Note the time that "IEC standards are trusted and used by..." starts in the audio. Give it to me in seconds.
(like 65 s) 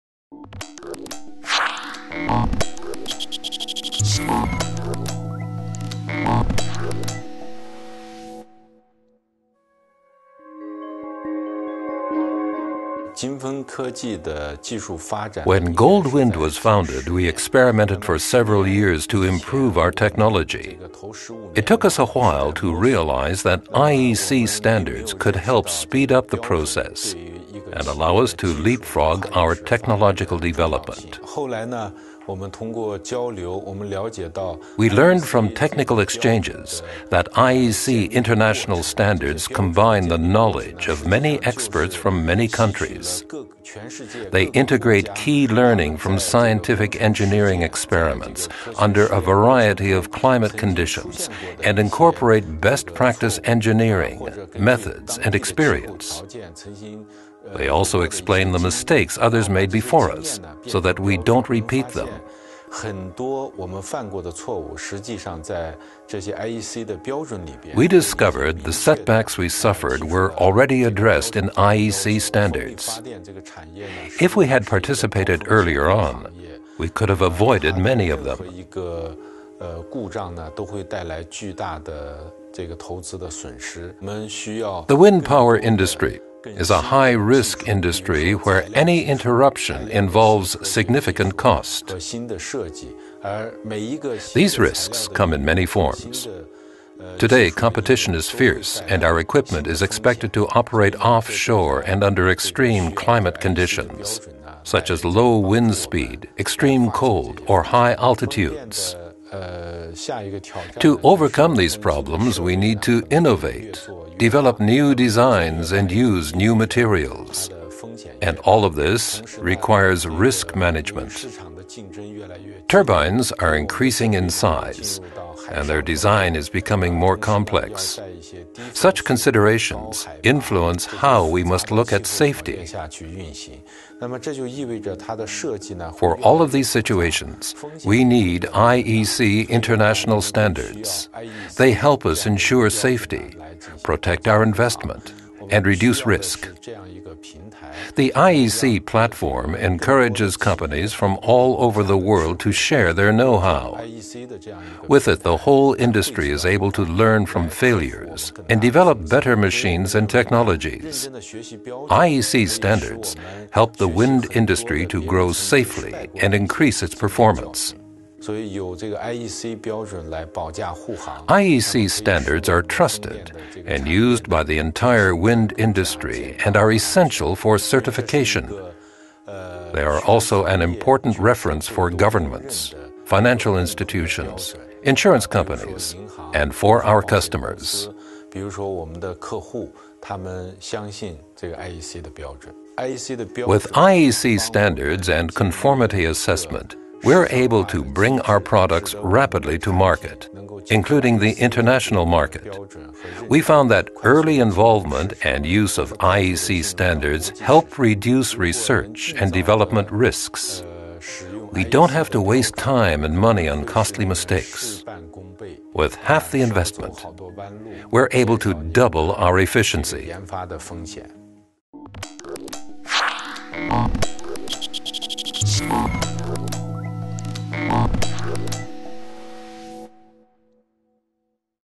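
171 s.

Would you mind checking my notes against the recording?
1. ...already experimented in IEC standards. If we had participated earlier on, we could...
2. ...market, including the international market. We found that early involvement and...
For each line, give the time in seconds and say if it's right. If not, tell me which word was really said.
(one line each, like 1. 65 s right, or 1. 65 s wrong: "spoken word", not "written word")
1. 70 s wrong: "addressed", not "experimented"
2. 199 s right.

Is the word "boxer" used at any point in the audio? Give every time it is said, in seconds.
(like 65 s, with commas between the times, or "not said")
not said.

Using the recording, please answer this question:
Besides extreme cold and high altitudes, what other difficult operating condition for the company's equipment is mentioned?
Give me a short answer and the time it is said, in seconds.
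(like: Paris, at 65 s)
Low wind speed, at 105 s.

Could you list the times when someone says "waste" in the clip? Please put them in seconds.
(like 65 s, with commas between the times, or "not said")
212 s.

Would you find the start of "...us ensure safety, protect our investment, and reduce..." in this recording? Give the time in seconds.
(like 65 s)
142 s.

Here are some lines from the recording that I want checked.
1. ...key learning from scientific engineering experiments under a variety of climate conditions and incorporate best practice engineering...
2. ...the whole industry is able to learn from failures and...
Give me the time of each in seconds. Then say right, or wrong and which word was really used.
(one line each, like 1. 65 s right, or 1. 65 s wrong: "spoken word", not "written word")
1. 45 s right
2. 155 s right.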